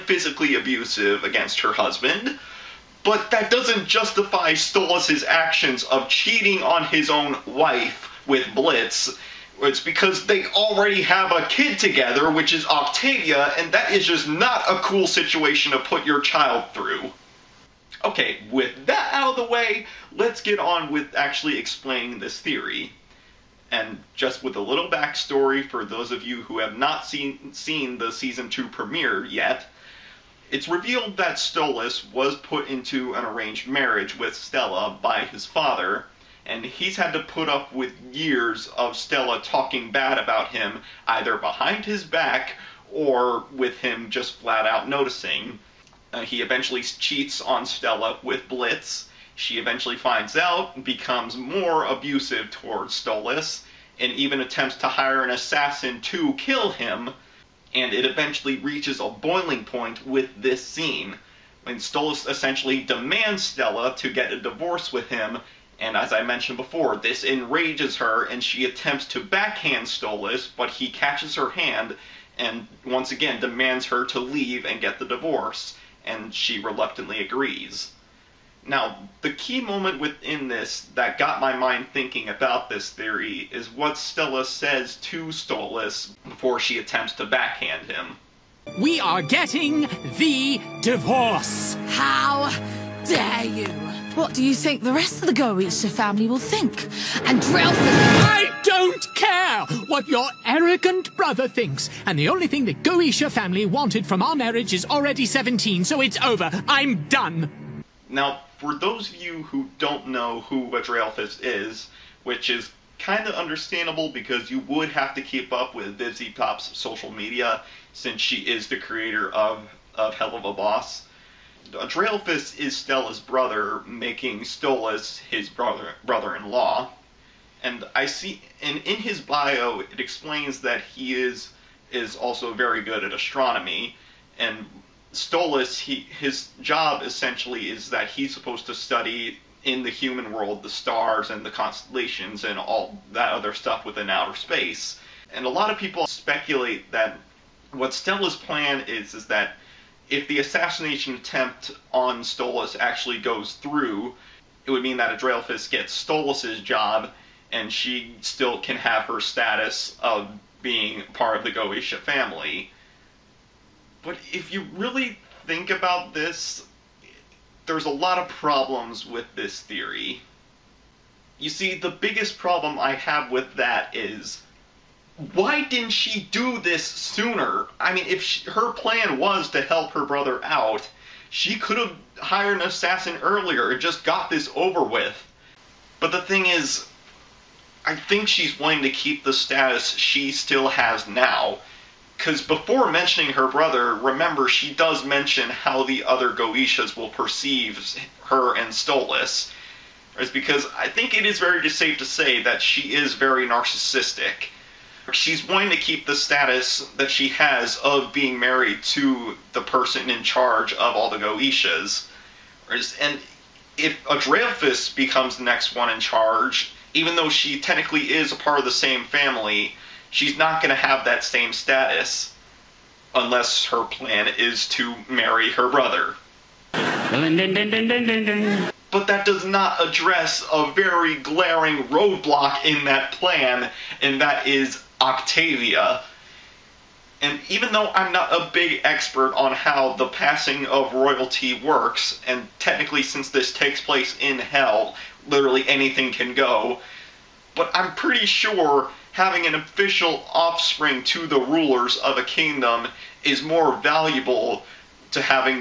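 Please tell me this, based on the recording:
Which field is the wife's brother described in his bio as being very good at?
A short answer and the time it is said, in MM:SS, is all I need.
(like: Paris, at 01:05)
Astronomy, at 02:13.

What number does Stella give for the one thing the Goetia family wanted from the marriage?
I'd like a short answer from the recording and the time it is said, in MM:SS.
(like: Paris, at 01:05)
17, at 01:45.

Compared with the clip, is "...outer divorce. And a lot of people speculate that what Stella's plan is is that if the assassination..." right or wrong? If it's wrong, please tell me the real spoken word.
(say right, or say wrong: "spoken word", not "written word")
wrong: "space", not "divorce".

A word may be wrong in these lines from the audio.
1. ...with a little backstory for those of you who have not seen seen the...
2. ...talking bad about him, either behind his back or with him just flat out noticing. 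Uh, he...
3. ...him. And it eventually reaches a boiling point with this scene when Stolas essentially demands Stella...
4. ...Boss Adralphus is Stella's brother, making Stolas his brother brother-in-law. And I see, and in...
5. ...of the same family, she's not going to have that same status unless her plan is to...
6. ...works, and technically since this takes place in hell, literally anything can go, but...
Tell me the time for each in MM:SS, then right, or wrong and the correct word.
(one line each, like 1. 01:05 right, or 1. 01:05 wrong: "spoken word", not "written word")
1. 00:24 right
2. 00:39 right
3. 00:56 right
4. 02:00 right
5. 03:38 right
6. 04:01 right.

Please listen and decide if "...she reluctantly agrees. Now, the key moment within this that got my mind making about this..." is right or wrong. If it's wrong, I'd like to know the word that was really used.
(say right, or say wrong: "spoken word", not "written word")
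wrong: "thinking", not "making".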